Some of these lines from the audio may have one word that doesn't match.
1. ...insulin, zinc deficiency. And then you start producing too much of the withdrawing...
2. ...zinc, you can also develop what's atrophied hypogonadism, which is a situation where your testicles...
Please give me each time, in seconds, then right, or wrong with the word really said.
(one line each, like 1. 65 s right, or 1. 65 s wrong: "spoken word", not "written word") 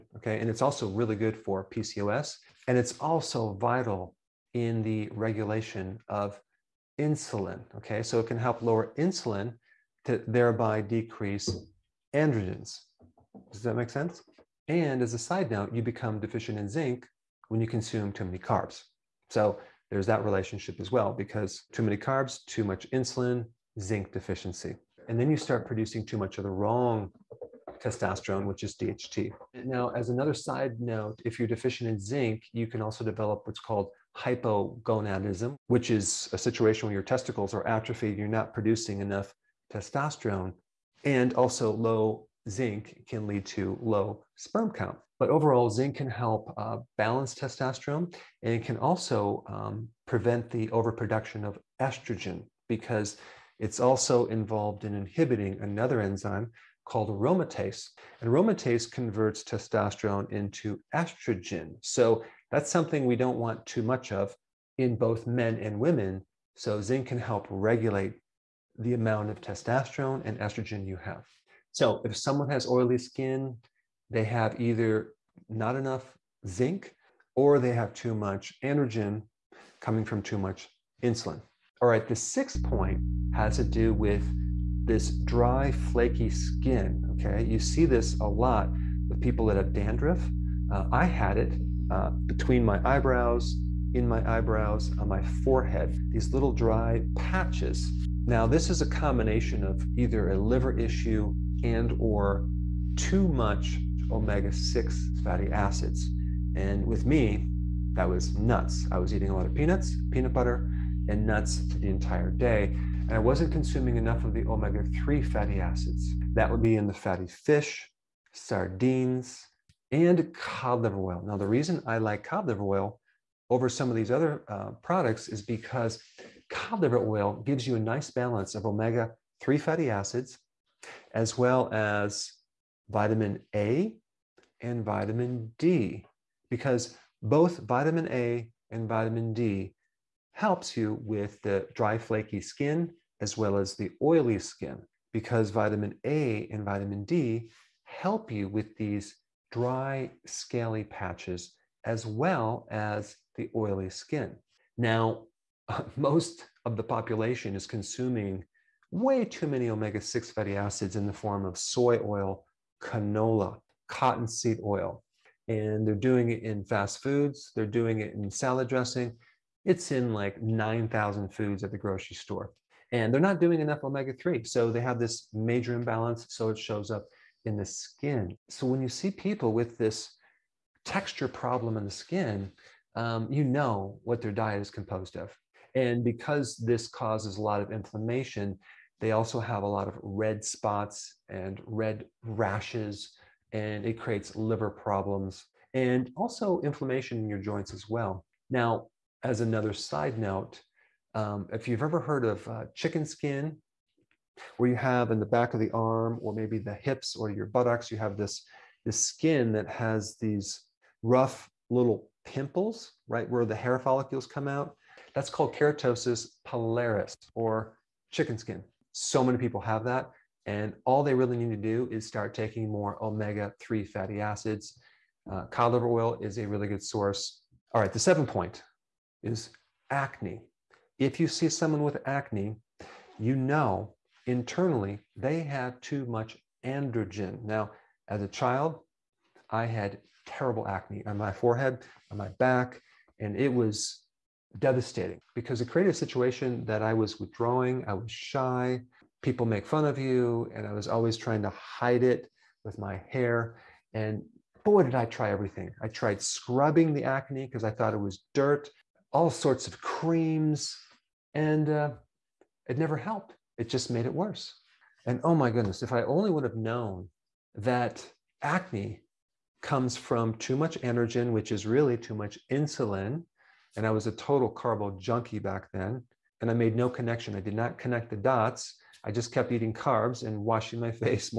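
1. 22 s wrong: "wrong", not "withdrawing"
2. 31 s wrong: "called", not "atrophied".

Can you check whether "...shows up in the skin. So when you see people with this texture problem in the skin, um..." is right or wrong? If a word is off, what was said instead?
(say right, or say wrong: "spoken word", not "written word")
right.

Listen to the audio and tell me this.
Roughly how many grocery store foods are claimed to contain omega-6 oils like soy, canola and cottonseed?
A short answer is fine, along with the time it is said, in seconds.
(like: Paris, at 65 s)
9,000, at 170 s.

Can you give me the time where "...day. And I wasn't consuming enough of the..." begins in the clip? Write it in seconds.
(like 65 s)
112 s.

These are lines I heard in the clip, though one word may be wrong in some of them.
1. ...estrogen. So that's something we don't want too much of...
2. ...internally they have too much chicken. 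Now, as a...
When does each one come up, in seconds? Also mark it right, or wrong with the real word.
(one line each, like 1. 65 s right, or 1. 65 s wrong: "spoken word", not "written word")
1. 60 s right
2. 234 s wrong: "androgen", not "chicken".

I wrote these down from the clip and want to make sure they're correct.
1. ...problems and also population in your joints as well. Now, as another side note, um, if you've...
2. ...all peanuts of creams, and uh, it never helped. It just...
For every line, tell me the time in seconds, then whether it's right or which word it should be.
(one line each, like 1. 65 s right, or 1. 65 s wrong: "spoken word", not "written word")
1. 194 s wrong: "inflammation", not "population"
2. 259 s wrong: "sorts", not "peanuts".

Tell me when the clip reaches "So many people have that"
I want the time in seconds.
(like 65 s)
218 s.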